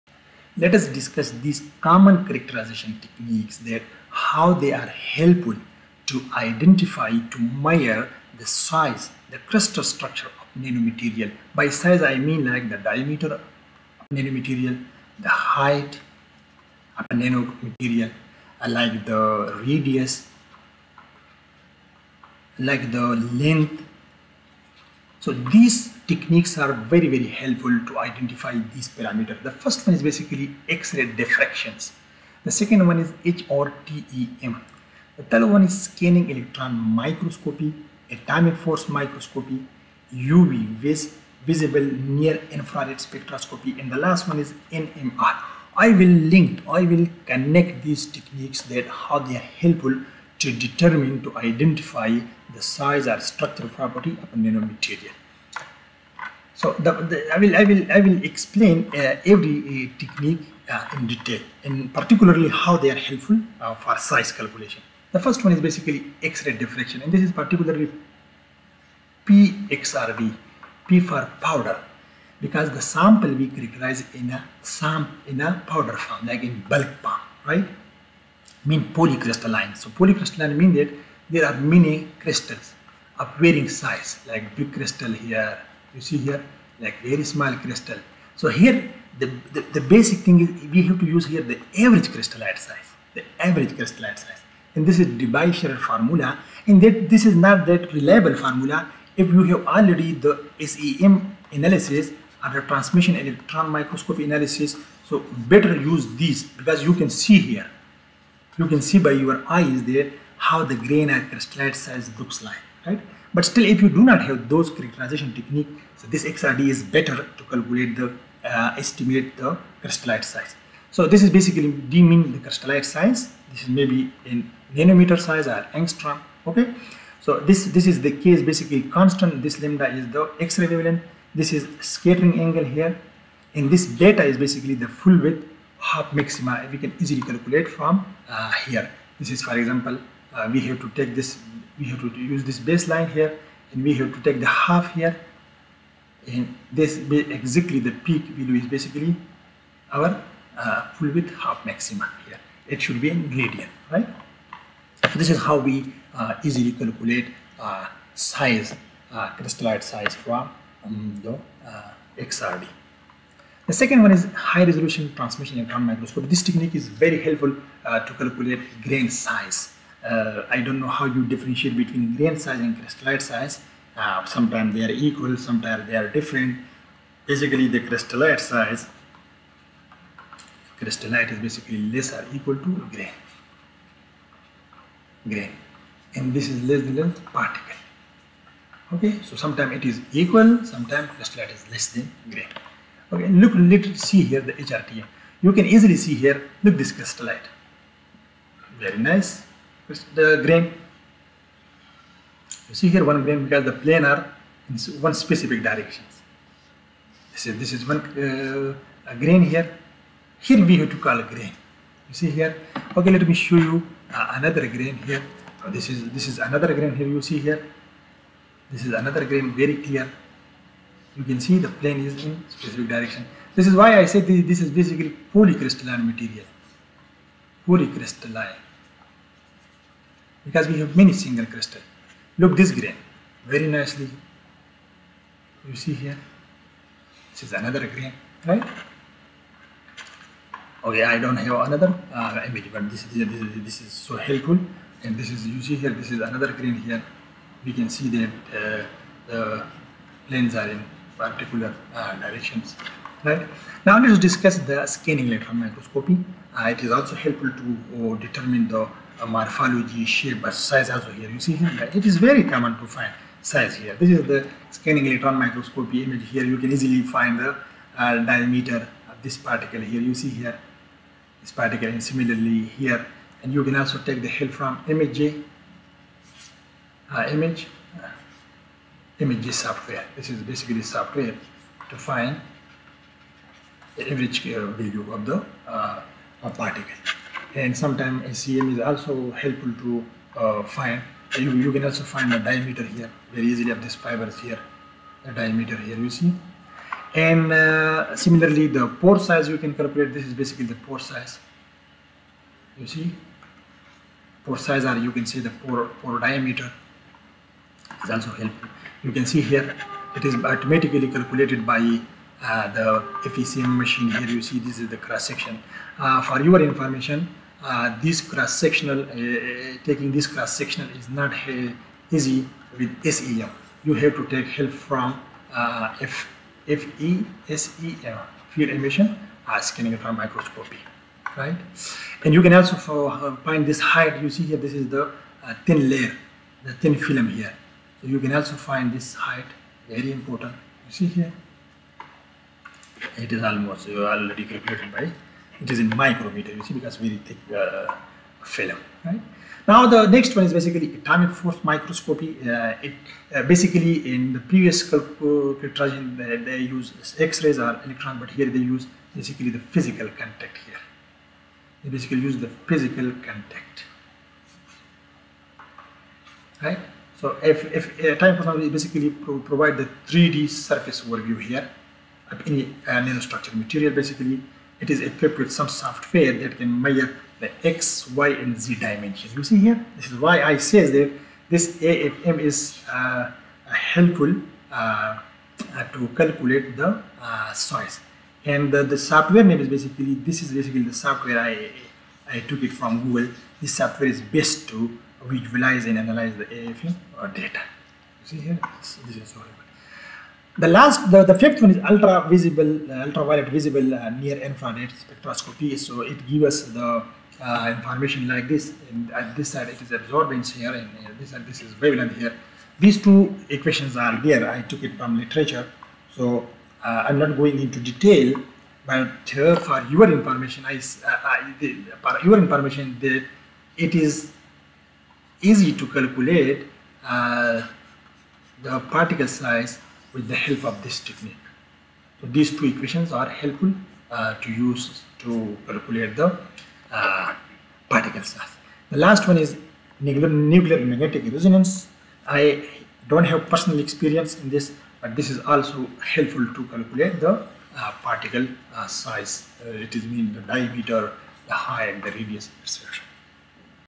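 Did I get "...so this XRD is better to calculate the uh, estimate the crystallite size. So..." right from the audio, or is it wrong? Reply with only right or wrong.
right.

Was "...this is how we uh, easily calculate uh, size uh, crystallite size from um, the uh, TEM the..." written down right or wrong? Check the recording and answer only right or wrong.
wrong.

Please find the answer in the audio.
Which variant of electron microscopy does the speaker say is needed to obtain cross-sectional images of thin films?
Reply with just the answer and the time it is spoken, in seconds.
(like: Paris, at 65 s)
field emission scanning electron microscopy, at 328 s.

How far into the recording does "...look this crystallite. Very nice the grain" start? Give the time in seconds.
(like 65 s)
196 s.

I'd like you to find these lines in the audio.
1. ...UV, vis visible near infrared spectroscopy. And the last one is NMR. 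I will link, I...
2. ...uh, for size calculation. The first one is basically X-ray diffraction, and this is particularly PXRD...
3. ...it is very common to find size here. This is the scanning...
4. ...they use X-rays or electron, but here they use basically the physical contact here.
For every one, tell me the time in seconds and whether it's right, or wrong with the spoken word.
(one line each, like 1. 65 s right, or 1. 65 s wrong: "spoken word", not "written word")
1. 40 s right
2. 63 s right
3. 261 s right
4. 356 s right.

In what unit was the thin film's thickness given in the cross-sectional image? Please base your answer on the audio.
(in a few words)
micrometer.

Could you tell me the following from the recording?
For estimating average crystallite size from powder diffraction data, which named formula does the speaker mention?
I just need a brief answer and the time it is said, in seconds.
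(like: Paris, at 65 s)
Debye-Scherrer formula, at 95 s.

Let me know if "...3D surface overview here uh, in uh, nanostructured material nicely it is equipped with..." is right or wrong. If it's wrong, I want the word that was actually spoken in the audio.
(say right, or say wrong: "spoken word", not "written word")
wrong: "basically", not "nicely".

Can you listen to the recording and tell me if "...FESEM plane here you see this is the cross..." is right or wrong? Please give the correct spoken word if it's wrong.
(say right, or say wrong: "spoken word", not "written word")
wrong: "machine", not "plane".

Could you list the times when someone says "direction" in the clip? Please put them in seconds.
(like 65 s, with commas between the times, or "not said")
205 s, 222 s, 252 s.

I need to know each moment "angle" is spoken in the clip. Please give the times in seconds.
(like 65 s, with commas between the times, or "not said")
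132 s.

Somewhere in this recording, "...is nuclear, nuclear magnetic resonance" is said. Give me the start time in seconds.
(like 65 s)
439 s.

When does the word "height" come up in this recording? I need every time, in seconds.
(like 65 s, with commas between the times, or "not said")
15 s, 333 s, 339 s, 451 s.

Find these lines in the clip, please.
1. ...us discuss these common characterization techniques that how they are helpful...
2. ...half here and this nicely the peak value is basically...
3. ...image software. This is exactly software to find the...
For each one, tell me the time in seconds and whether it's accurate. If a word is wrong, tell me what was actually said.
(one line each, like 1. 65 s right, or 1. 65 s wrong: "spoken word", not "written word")
1. 0 s right
2. 144 s wrong: "exactly", not "nicely"
3. 279 s wrong: "basically", not "exactly".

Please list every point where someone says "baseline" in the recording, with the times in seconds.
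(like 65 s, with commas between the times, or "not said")
142 s.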